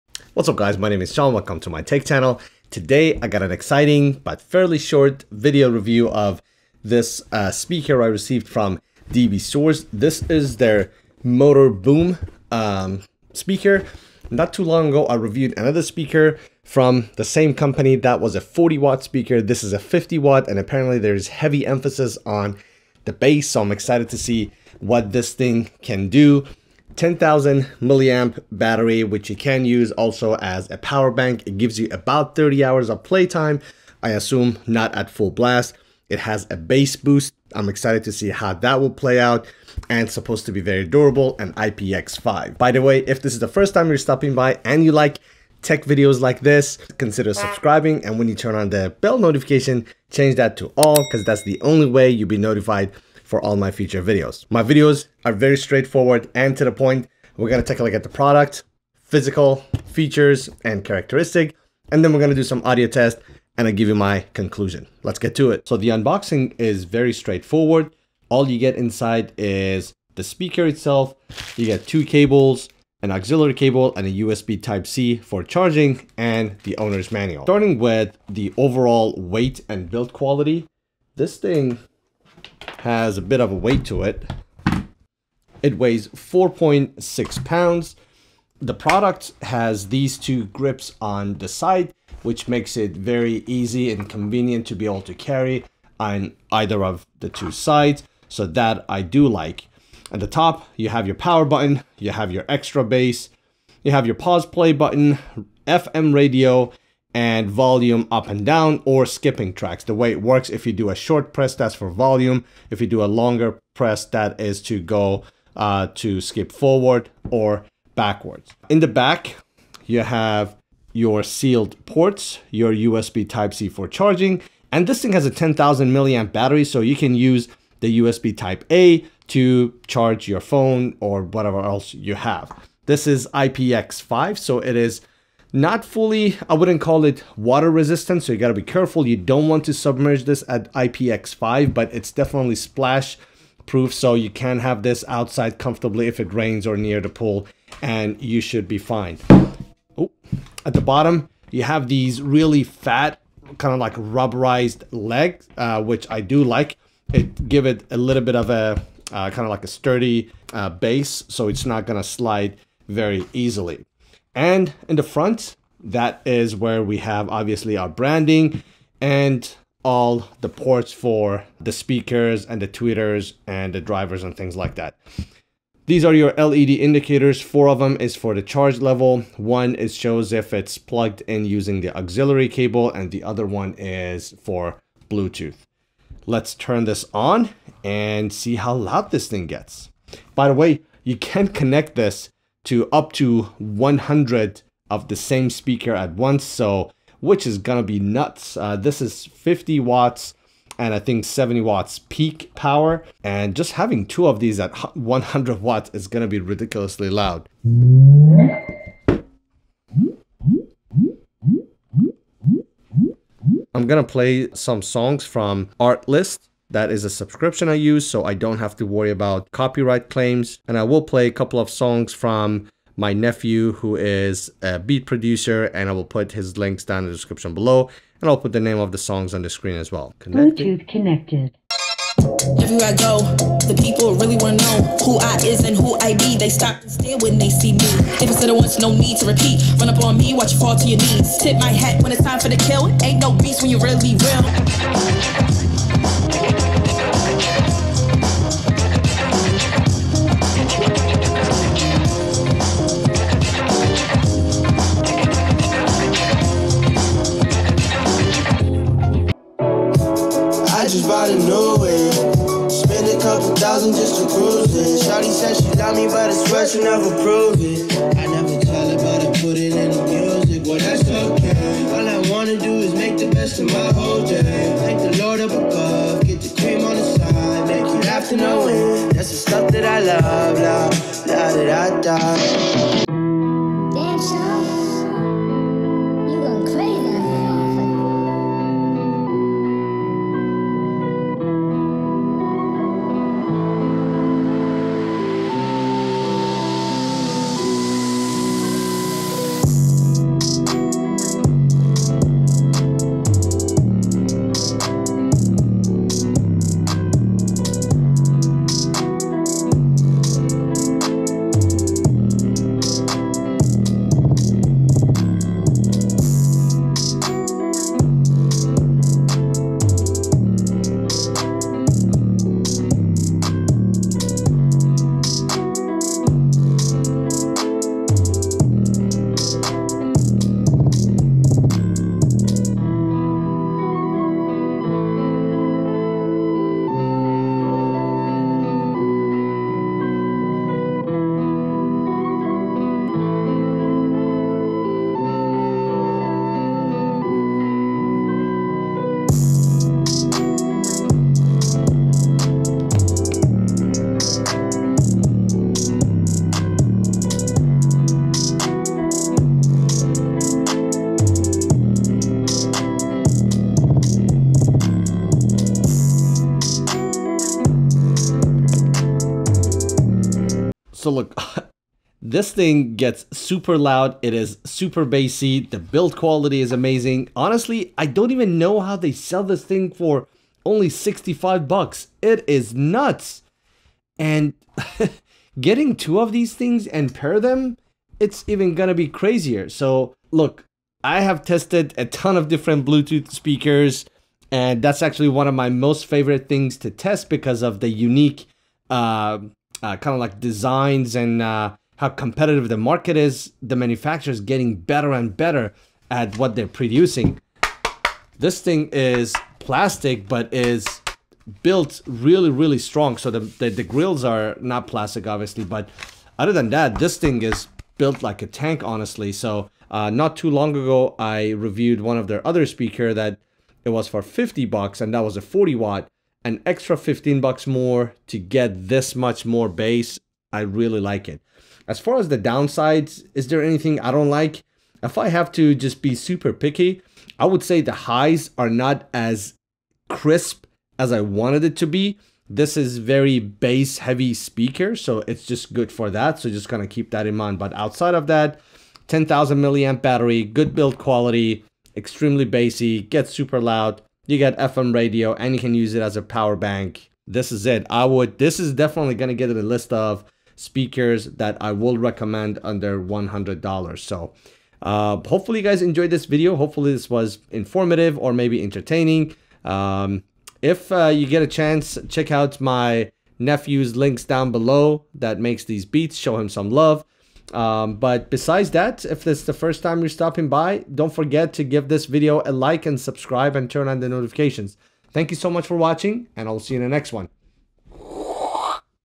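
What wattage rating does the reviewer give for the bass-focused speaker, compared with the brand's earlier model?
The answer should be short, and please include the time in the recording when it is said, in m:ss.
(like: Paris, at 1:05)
50 watt, at 0:19.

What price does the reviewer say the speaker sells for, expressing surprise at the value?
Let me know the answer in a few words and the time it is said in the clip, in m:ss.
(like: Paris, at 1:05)
$65, at 6:20.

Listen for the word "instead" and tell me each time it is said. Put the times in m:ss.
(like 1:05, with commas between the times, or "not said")
not said.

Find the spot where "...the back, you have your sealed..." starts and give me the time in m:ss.
1:58.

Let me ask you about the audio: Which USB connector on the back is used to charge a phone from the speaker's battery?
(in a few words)
USB Type-A.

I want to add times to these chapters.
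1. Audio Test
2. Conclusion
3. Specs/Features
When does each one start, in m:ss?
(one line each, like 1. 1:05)
1. 3:33
2. 6:10
3. 1:05.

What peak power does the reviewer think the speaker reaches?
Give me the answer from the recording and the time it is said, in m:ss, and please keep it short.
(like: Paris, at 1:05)
70 watts, at 3:21.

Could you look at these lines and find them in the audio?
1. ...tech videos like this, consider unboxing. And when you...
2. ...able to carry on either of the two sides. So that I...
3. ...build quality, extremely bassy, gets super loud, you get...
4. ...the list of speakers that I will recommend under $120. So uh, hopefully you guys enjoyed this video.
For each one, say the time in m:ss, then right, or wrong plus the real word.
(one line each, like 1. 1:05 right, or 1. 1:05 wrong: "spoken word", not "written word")
1. 0:45 wrong: "subscribing", not "unboxing"
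2. 1:34 right
3. 7:30 right
4. 7:39 wrong: "100", not "120".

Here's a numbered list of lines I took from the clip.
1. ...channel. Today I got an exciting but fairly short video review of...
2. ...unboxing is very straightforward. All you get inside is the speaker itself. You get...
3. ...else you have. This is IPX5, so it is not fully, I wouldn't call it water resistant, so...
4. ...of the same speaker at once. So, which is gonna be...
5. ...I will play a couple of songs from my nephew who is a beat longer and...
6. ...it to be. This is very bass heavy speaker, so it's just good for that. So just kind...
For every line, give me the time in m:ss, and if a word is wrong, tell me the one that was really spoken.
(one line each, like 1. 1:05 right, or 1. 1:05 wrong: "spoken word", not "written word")
1. 0:02 right
2. 1:05 right
3. 2:11 right
4. 3:14 right
5. 3:40 wrong: "producer", not "longer"
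6. 7:21 right.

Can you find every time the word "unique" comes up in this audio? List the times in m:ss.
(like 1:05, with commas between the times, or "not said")
6:37.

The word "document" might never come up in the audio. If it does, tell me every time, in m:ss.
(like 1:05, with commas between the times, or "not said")
not said.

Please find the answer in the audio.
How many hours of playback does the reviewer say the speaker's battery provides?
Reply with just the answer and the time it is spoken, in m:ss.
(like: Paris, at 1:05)
30 hours, at 0:32.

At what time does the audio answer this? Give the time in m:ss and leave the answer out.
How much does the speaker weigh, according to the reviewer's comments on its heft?
1:26.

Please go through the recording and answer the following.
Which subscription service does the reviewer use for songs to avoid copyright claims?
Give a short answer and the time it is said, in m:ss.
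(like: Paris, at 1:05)
Artlist, at 3:35.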